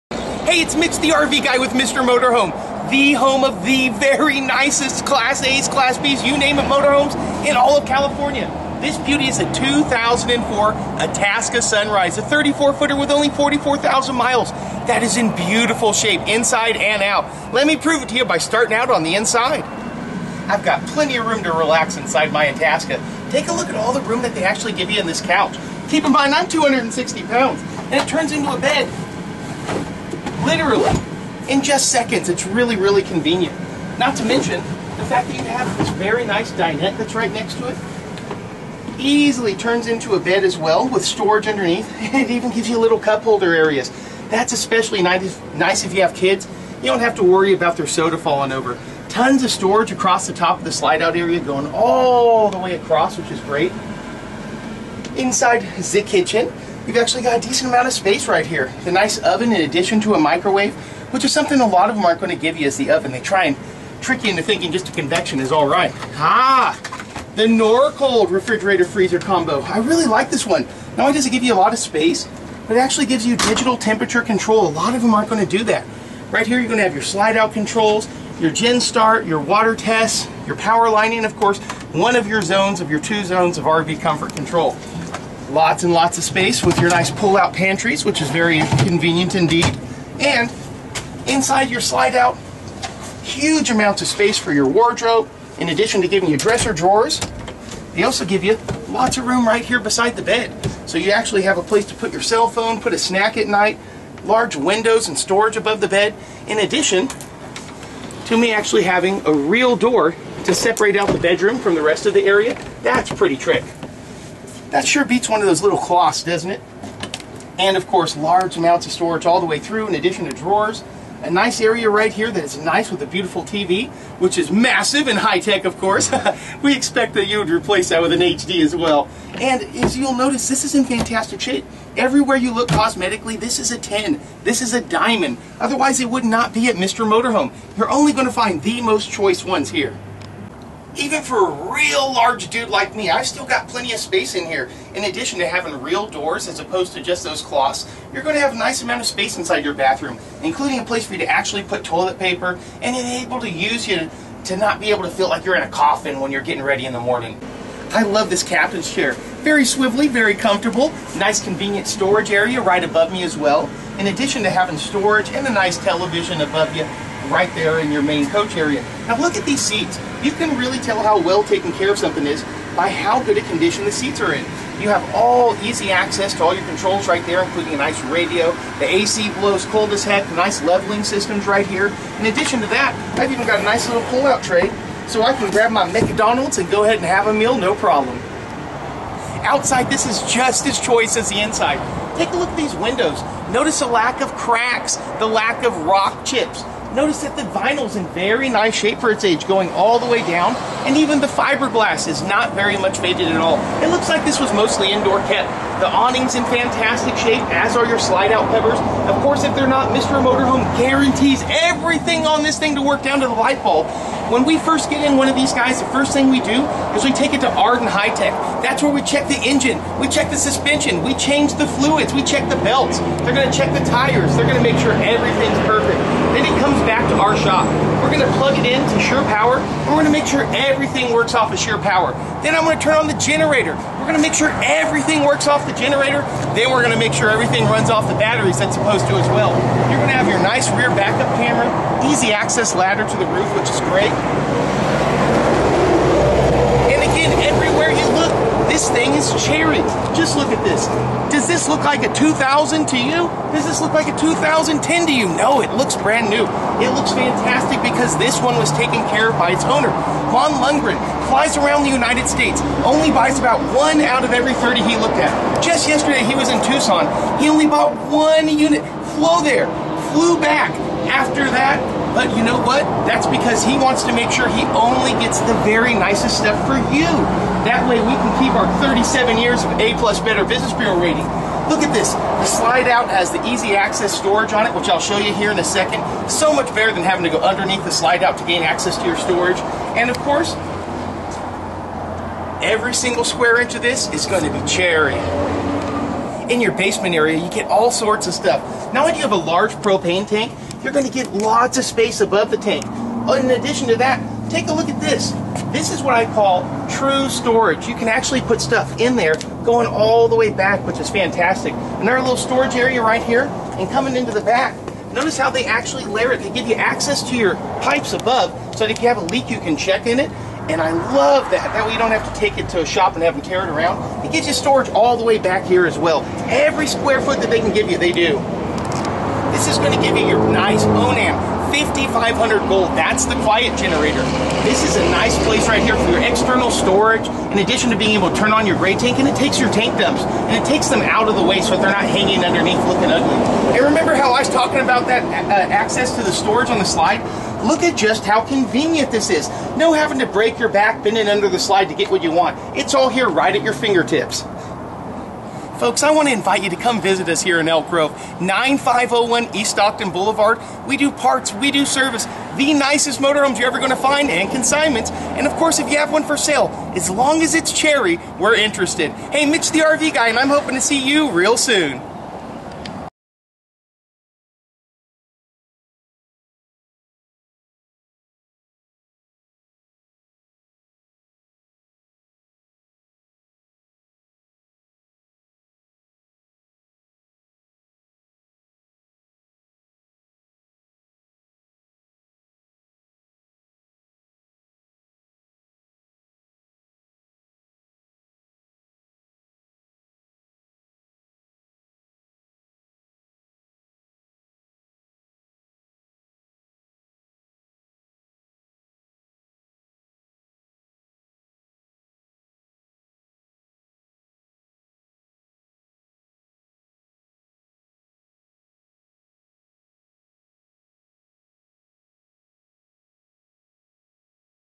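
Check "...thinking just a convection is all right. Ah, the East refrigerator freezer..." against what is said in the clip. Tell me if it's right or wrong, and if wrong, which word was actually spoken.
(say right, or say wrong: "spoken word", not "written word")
wrong: "Norcold", not "East".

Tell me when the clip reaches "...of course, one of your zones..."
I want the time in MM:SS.
01:21.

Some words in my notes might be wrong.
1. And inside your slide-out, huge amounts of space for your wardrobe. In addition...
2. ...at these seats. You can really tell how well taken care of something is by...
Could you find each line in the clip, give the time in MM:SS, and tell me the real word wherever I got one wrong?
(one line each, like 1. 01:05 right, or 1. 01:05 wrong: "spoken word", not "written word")
1. 01:30 right
2. 02:49 right.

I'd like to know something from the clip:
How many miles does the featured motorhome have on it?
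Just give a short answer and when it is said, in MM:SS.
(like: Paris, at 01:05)
44,000, at 00:13.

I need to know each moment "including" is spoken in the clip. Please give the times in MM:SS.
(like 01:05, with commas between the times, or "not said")
02:30, 02:57.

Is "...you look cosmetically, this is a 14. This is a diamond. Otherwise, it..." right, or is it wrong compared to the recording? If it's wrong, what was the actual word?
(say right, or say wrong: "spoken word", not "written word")
wrong: "10", not "14".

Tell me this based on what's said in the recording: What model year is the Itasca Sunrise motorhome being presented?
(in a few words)
2004.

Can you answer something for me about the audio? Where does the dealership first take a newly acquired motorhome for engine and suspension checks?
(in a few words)
Arden High Tech.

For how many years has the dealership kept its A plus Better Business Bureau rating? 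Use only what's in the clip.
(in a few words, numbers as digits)
37.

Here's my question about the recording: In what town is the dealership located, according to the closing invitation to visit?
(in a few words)
Elk Grove.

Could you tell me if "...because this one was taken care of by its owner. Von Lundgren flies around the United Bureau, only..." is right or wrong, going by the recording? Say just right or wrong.
wrong.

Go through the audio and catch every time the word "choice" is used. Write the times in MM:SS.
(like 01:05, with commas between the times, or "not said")
02:19, 03:10.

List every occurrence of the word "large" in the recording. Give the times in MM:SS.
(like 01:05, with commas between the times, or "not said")
01:44, 01:58, 02:22, 04:59.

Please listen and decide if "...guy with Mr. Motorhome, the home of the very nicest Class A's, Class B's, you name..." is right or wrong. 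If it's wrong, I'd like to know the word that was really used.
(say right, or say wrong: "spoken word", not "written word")
right.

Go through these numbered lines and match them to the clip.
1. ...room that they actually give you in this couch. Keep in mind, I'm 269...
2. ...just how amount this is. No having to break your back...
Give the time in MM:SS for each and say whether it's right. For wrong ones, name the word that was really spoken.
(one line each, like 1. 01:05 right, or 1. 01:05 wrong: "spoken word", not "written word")
1. 00:24 wrong: "260", not "269"
2. 05:47 wrong: "convenient", not "amount".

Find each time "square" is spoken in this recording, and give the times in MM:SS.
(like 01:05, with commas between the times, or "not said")
04:53, 05:26.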